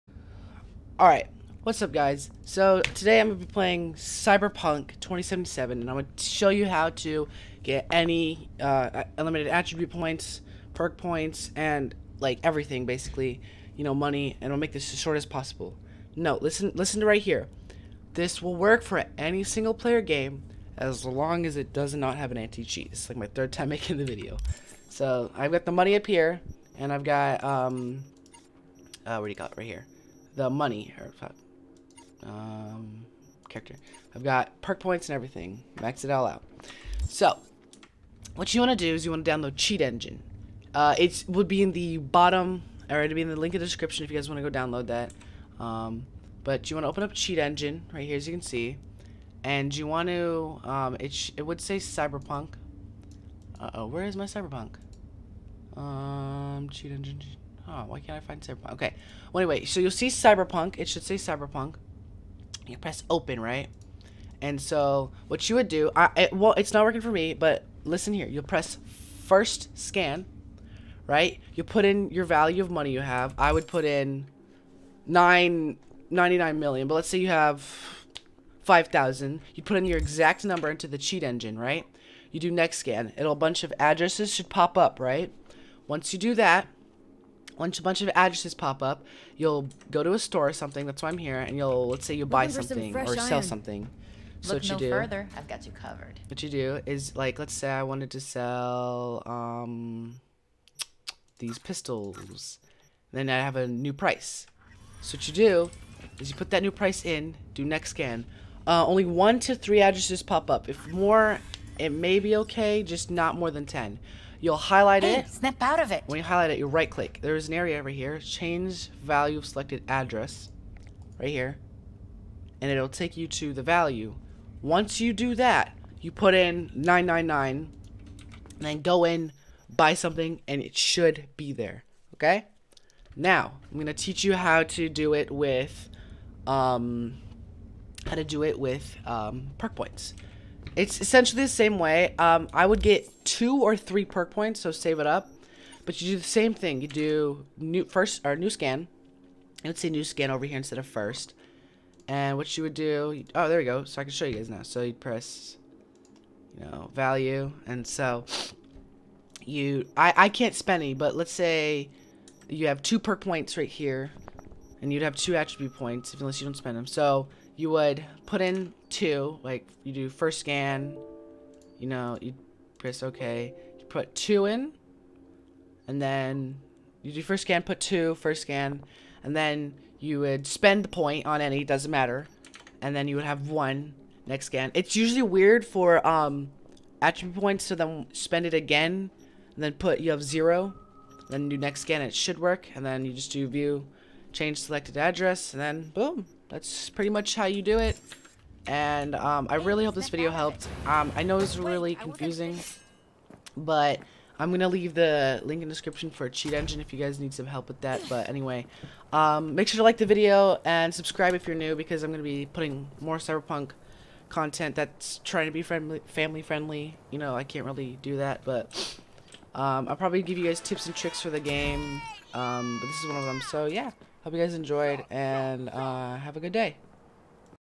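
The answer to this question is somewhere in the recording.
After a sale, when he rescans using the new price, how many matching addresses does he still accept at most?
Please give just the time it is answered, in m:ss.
1:53.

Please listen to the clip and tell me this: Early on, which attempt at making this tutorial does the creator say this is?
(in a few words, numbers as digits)
third time.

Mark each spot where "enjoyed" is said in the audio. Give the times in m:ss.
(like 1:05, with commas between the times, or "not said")
3:44.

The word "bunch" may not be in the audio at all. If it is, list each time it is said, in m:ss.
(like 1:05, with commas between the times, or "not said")
1:23, 1:27.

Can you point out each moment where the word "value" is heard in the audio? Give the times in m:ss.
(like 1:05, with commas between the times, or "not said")
1:12, 1:59, 2:03, 2:36.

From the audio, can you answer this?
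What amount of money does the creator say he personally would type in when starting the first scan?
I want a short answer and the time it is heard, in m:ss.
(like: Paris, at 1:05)
99 million, at 1:16.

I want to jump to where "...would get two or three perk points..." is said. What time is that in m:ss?
2:22.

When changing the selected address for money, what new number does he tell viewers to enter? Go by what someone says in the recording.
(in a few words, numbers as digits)
999.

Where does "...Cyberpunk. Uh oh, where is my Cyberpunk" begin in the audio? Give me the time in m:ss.
0:51.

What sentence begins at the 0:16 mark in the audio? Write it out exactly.
No, listen, listen to right here.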